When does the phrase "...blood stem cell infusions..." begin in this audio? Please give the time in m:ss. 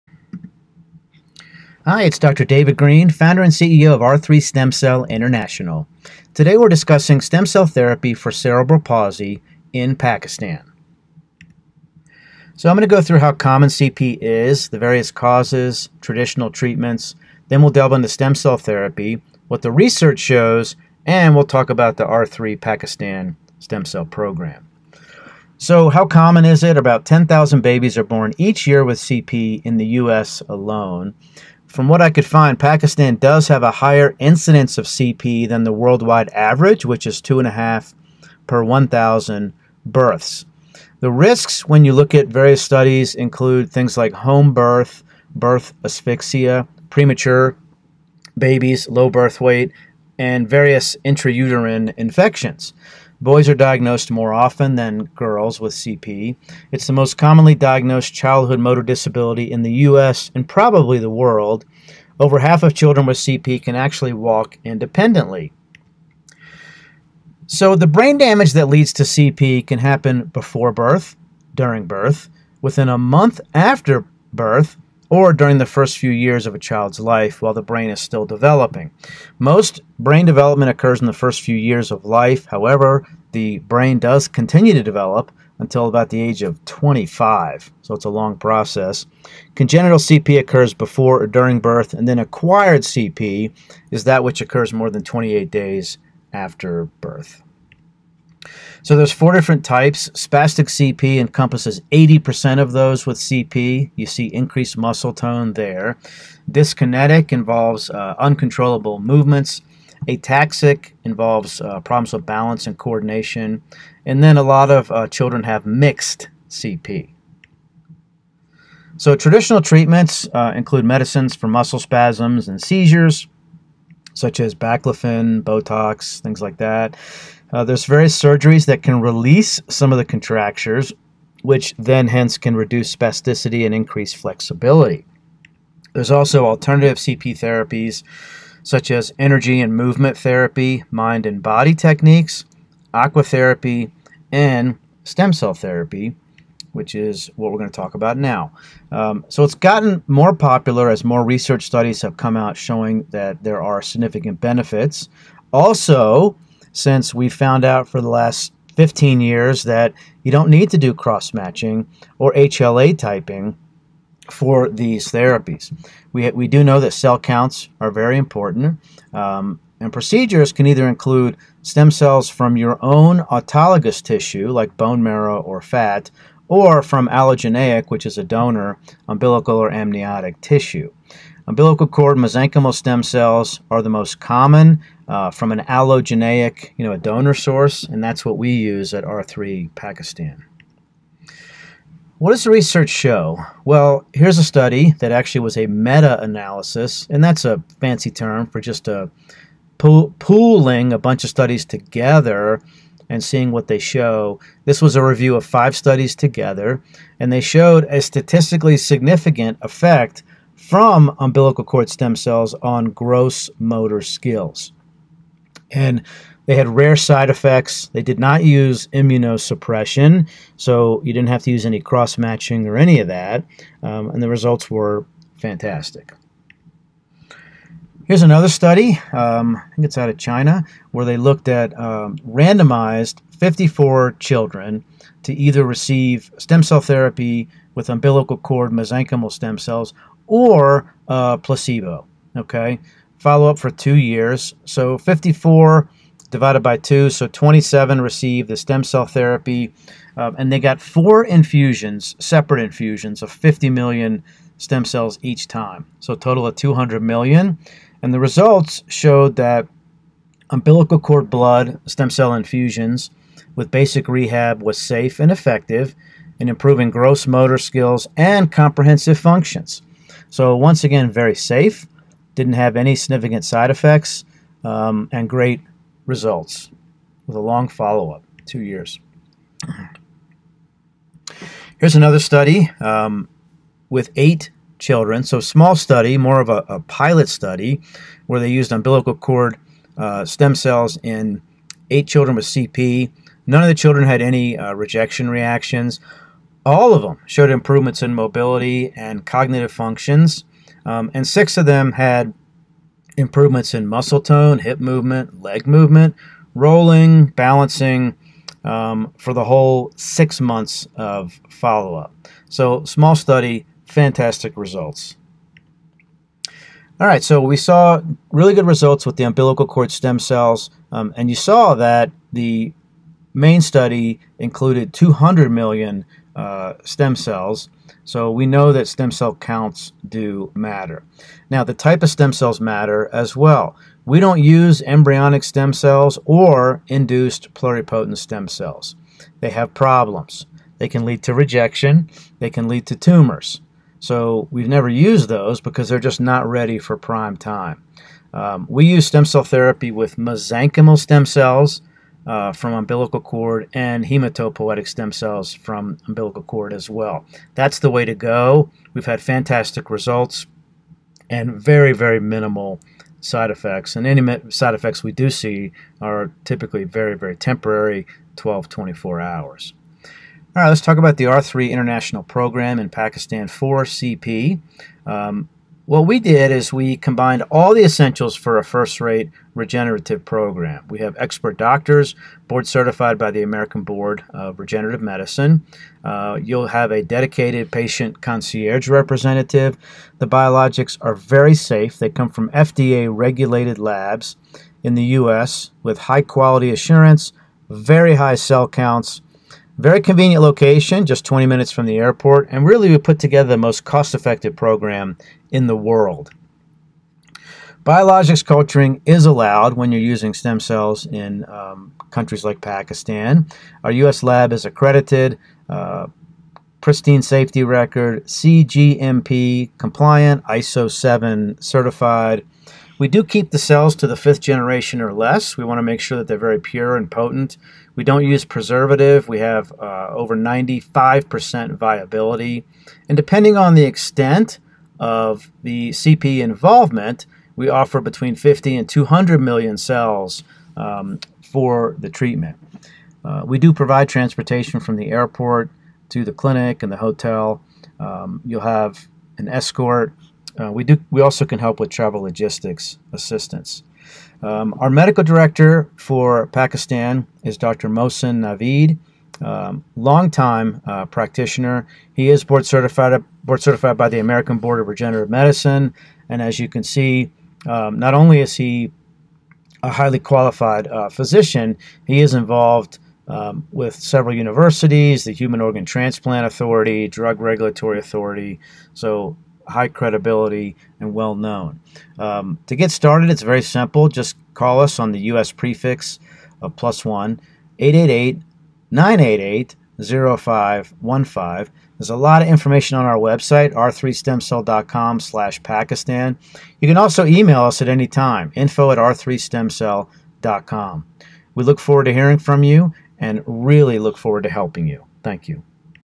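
4:21.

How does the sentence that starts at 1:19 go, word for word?
Most brain development occurs in the first few years of life.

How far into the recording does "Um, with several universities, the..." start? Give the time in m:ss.
7:53.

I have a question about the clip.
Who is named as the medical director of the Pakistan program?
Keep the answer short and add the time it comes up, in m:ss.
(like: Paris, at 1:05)
Dr. Mohsen Navid, at 7:37.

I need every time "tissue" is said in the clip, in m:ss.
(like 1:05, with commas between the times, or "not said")
2:54, 3:00.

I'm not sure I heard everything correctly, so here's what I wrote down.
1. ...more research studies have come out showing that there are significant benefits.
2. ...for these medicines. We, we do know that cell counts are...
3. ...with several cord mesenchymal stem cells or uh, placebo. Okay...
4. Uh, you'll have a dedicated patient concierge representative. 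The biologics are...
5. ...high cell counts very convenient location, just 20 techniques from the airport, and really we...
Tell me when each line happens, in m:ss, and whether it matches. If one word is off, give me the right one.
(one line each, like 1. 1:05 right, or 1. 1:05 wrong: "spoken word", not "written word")
1. 2:31 right
2. 2:44 wrong: "therapies", not "medicines"
3. 3:57 wrong: "umbilical", not "several"
4. 6:26 right
5. 6:38 wrong: "minutes", not "techniques".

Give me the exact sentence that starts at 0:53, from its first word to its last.
Boys are diagnosed more often than girls with CP.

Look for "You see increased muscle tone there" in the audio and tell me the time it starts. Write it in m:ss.
1:43.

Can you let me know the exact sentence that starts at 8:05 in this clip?
prefix of plus one, 888 988 0515.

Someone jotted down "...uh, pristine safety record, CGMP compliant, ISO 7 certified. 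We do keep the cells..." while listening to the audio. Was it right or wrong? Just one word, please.
right.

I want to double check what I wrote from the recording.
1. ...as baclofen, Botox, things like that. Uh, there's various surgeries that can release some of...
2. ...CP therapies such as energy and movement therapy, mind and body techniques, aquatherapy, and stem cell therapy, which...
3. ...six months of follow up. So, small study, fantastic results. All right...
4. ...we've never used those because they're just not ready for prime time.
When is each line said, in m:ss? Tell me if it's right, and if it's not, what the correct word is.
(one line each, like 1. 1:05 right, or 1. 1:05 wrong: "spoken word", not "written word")
1. 2:04 right
2. 2:16 right
3. 5:09 right
4. 5:44 right.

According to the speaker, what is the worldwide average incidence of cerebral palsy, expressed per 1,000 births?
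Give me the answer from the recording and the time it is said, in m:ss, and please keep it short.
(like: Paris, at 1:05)
2.5 per 1,000, at 0:37.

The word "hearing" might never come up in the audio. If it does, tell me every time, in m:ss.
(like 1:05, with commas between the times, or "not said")
8:22.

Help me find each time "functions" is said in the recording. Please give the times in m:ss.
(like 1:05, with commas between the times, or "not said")
4:29, 4:59.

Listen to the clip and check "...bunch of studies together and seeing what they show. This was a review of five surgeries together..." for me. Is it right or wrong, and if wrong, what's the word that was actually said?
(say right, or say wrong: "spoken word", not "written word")
wrong: "studies", not "surgeries".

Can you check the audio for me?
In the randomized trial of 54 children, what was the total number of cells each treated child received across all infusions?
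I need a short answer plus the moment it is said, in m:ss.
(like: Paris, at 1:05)
200 million, at 4:16.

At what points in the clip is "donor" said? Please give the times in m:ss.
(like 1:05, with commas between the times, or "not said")
2:58, 3:06.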